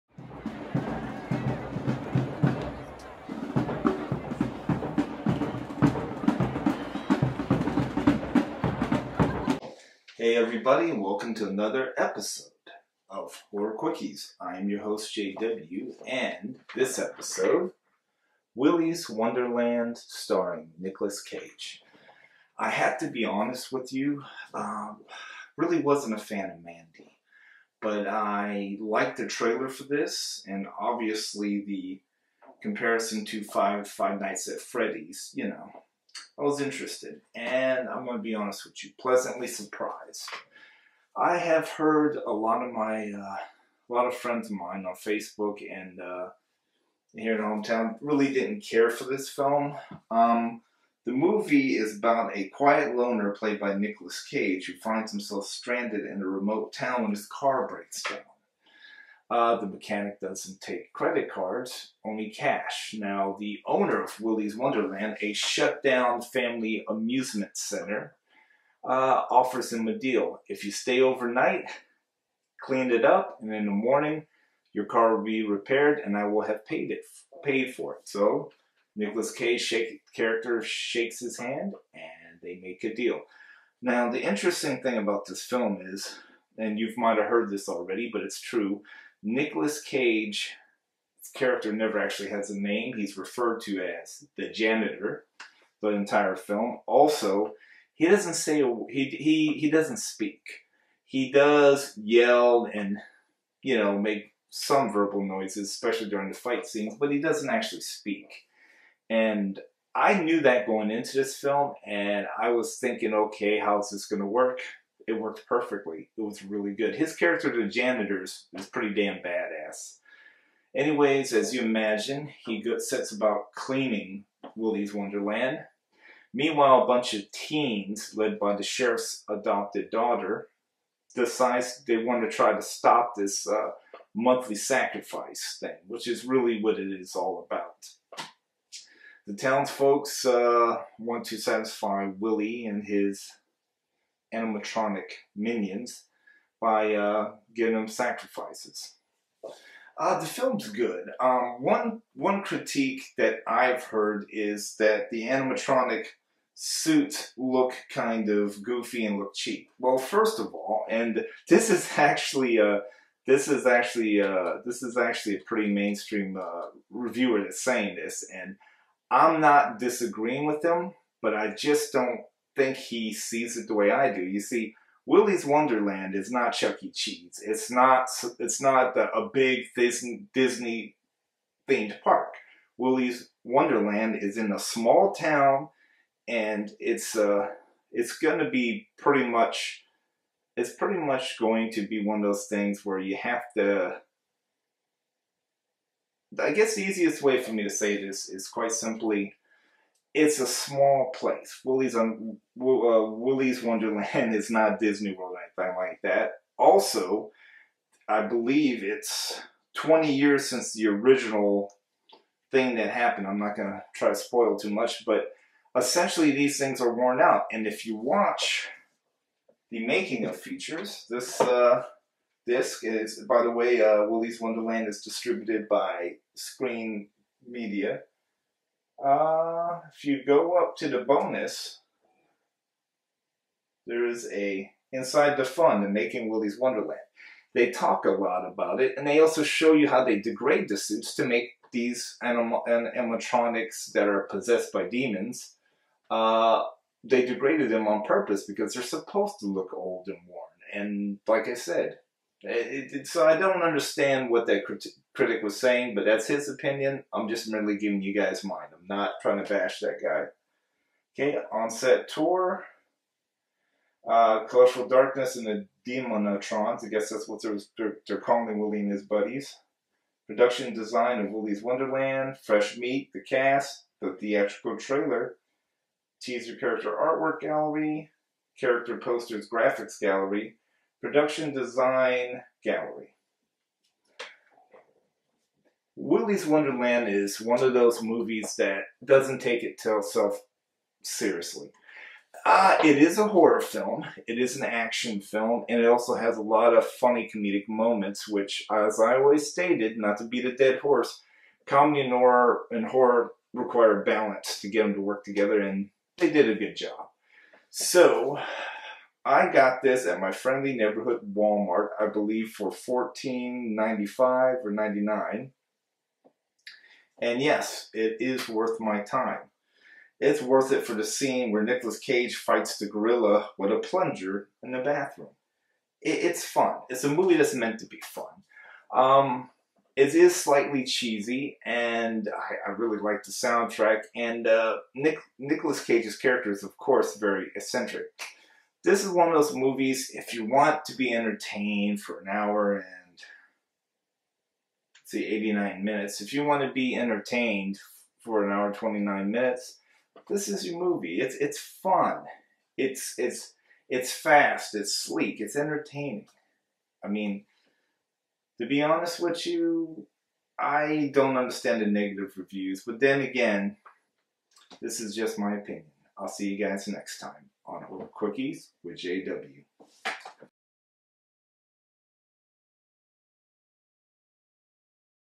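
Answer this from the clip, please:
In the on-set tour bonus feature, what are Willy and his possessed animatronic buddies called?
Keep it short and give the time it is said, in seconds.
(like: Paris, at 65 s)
Demonotrons, at 265 s.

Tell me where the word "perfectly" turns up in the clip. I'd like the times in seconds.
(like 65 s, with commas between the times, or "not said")
115 s.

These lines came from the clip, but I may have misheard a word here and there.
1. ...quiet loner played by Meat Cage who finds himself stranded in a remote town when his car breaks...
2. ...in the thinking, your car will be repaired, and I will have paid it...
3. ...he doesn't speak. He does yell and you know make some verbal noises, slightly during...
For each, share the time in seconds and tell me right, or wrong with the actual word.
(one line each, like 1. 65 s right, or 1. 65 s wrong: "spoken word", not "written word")
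1. 52 s wrong: "Nicolas", not "Meat"
2. 73 s wrong: "morning", not "thinking"
3. 99 s wrong: "especially", not "slightly".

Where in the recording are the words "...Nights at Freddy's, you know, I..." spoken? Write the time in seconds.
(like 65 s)
34 s.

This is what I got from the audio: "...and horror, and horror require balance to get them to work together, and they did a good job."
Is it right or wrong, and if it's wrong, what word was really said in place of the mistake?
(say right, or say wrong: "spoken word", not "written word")
right.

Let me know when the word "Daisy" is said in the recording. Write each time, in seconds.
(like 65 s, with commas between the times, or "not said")
not said.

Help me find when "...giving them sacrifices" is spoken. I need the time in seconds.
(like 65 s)
147 s.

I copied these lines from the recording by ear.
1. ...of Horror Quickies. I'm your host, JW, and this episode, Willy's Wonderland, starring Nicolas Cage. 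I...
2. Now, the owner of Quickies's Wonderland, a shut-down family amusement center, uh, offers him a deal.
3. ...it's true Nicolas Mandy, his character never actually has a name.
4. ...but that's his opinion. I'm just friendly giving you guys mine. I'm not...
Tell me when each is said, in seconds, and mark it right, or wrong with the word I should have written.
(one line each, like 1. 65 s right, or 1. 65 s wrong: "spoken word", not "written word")
1. 13 s right
2. 62 s wrong: "Willy", not "Quickies"
3. 88 s wrong: "Cage", not "Mandy"
4. 255 s wrong: "merely", not "friendly".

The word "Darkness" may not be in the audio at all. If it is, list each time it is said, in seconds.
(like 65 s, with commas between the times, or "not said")
264 s.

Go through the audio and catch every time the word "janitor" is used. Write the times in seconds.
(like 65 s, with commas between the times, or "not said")
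94 s, 117 s.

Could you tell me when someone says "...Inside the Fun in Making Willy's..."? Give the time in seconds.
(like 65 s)
234 s.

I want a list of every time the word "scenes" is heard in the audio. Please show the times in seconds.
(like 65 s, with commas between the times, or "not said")
106 s, 321 s.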